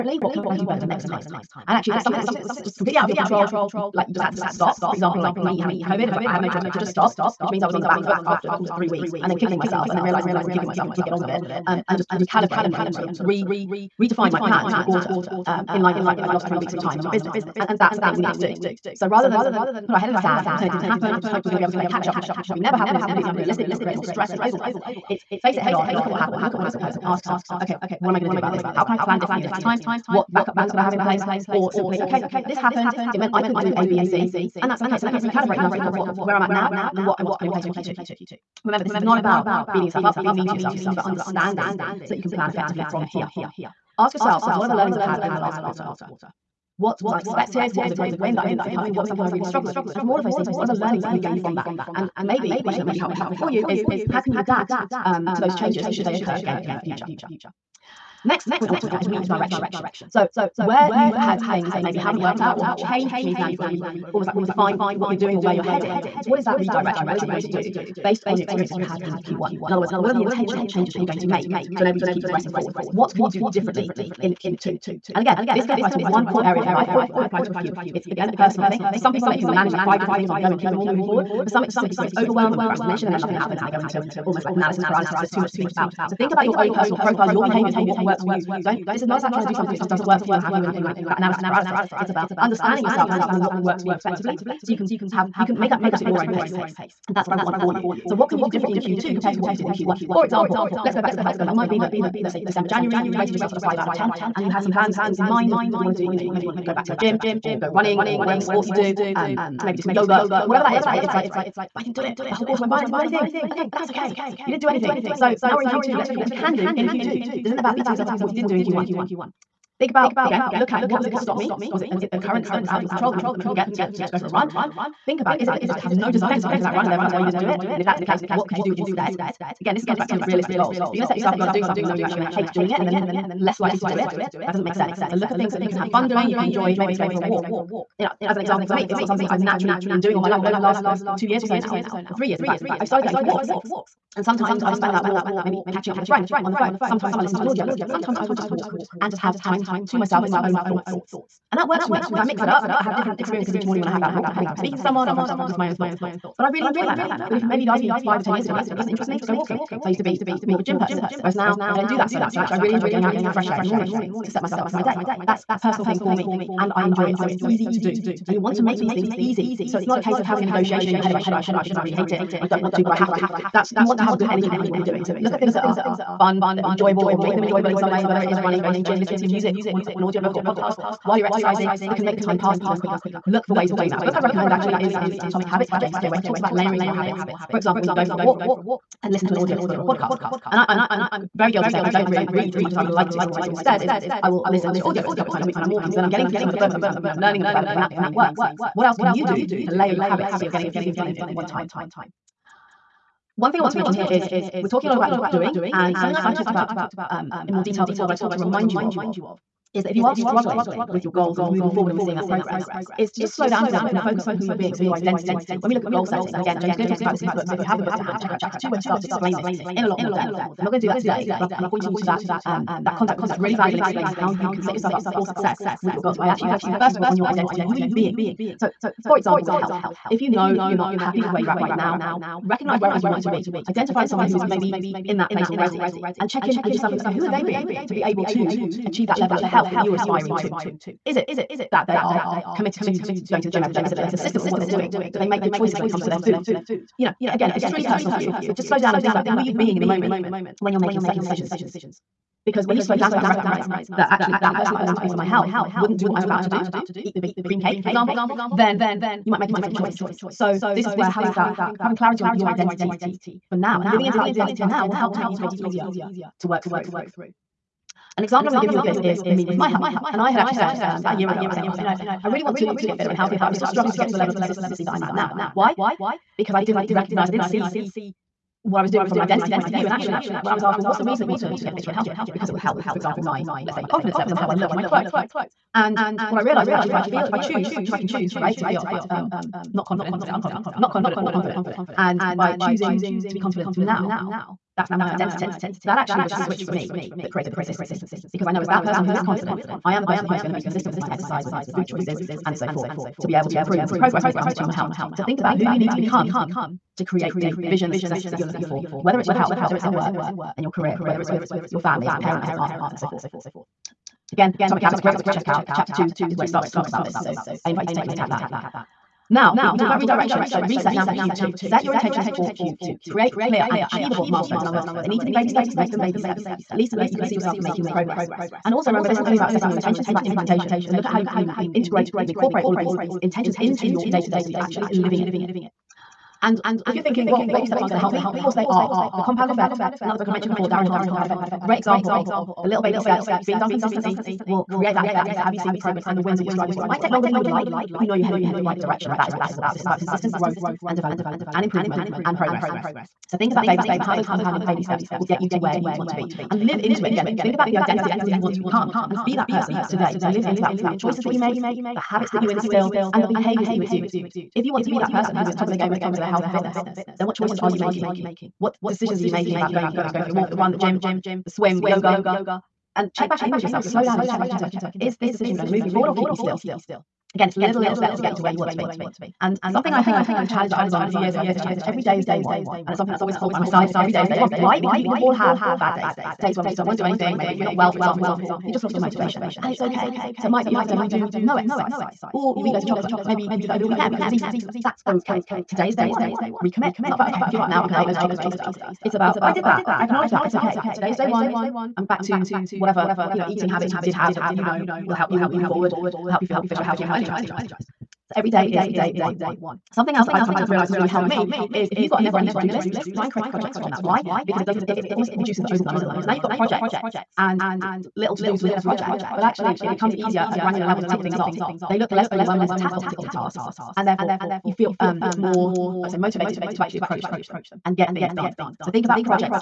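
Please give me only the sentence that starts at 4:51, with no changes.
And by choosing to be confident now, that's now my identity.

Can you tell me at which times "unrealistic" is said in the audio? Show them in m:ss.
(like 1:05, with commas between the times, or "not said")
0:23.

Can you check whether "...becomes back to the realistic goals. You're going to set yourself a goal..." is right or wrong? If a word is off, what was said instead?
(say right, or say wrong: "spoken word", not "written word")
wrong: "comes", not "becomes".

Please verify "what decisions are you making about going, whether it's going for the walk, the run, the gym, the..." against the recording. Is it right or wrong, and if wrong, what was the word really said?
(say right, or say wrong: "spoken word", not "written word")
right.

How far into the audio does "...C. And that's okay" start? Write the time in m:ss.
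0:34.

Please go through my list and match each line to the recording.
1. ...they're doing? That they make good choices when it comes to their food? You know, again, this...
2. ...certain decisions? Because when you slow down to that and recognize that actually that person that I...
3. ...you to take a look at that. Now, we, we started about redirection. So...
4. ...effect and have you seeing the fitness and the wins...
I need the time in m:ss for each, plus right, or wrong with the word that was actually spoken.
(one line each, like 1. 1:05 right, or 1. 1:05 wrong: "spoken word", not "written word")
1. 4:04 right
2. 4:11 right
3. 5:17 wrong: "talked", not "started"
4. 5:45 wrong: "progress", not "fitness".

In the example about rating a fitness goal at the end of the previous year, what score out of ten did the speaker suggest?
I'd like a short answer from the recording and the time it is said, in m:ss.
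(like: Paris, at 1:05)
5, at 1:43.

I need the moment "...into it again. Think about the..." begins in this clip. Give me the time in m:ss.
5:56.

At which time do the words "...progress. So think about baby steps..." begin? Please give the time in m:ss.
5:52.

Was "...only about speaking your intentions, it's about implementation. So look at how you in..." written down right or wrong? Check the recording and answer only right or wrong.
wrong.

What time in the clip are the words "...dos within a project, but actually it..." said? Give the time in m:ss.
6:58.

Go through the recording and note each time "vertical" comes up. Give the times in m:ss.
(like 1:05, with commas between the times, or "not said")
not said.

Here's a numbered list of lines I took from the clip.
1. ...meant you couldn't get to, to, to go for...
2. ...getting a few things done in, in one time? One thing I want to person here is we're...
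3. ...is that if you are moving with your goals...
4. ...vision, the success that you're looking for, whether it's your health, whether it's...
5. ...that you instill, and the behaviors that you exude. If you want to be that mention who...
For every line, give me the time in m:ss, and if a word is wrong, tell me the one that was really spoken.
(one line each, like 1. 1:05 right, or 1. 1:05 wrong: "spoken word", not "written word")
1. 2:03 right
2. 3:20 wrong: "mention", not "person"
3. 3:29 wrong: "struggling", not "moving"
4. 5:07 right
5. 6:02 wrong: "person", not "mention".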